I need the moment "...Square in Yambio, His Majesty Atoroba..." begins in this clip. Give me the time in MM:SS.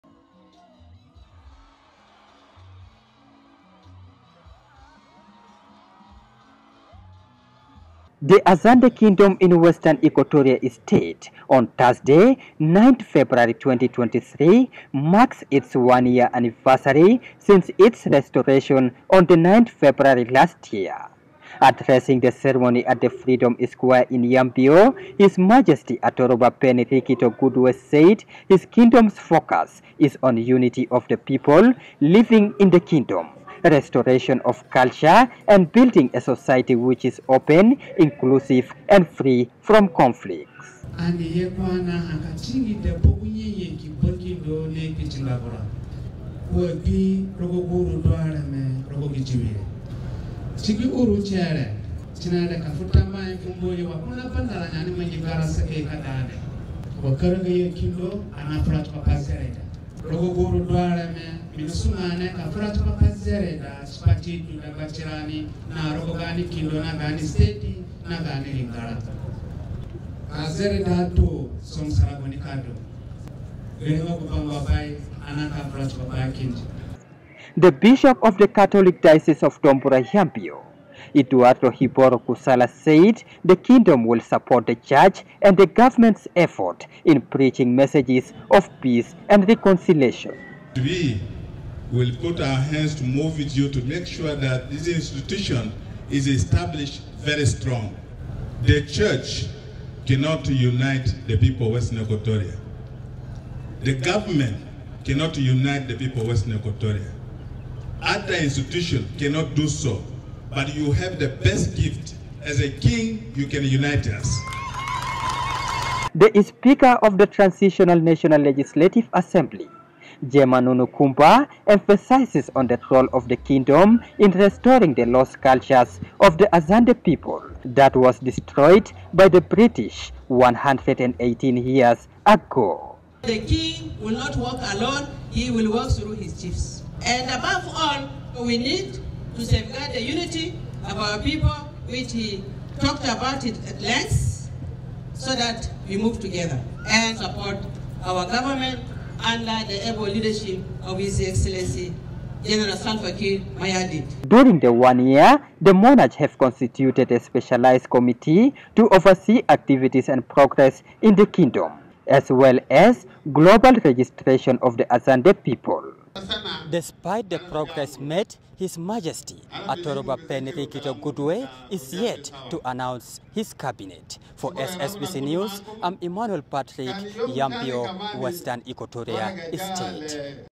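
00:23.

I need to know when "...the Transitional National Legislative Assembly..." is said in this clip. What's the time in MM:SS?
01:57.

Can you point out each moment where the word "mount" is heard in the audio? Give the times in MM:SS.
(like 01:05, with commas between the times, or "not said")
not said.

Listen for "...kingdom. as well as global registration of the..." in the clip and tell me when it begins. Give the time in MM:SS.
02:41.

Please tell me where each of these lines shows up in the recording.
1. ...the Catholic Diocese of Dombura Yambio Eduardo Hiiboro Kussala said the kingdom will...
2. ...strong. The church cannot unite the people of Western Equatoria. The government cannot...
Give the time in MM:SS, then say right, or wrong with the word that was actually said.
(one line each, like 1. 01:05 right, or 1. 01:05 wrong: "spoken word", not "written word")
1. 01:18 right
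2. 01:37 right.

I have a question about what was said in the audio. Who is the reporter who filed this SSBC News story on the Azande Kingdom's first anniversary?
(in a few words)
Emmanuel Patrick.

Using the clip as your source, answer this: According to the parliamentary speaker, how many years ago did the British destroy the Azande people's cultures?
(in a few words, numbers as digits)
118.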